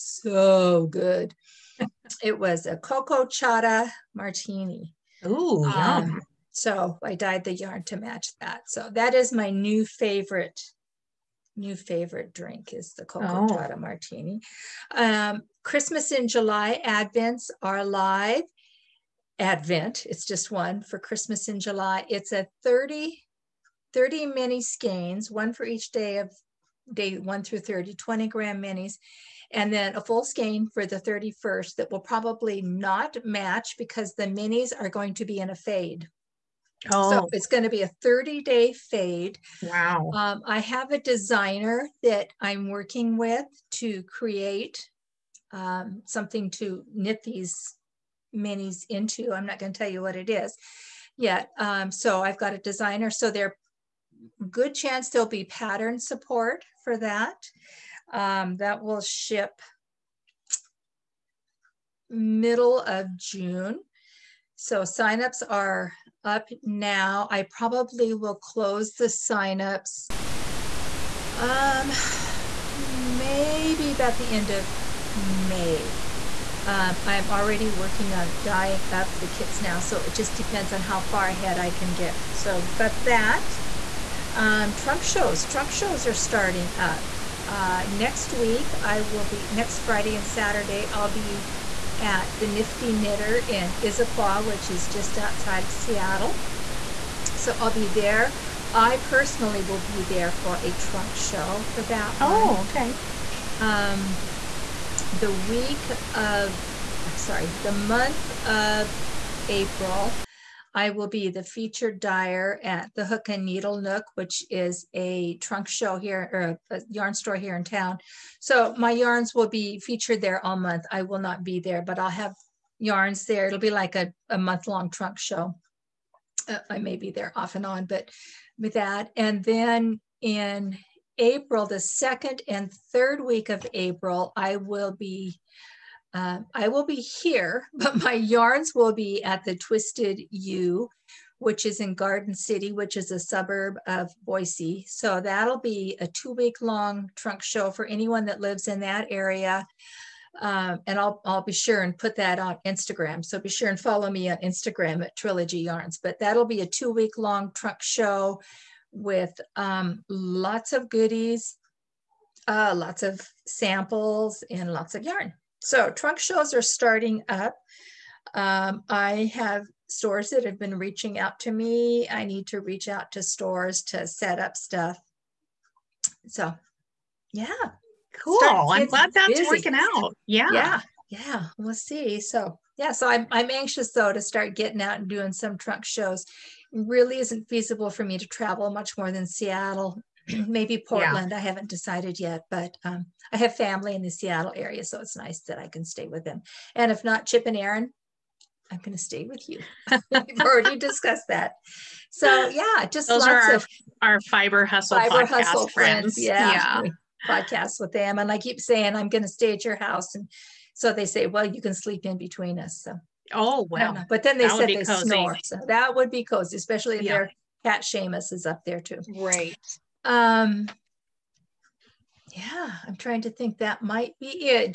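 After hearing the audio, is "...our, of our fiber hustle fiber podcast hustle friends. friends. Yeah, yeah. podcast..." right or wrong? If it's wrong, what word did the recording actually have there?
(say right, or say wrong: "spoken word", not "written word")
right.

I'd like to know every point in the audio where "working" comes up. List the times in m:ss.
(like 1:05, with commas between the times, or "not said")
0:42, 1:17, 2:59.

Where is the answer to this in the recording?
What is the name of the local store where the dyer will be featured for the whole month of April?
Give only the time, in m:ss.
1:53.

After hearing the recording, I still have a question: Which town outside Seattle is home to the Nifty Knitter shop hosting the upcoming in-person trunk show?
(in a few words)
Issaquah.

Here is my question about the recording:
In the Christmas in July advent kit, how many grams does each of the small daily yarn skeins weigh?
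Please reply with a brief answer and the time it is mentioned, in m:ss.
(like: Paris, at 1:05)
20 grams, at 0:27.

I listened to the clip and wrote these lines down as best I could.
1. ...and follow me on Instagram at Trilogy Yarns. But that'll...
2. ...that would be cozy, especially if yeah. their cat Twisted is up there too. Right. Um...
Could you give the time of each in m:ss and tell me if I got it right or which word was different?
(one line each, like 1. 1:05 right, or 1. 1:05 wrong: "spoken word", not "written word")
1. 2:33 right
2. 3:35 wrong: "Seamus", not "Twisted".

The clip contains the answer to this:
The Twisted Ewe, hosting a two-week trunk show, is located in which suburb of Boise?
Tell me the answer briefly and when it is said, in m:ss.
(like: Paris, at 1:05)
Garden City, at 2:21.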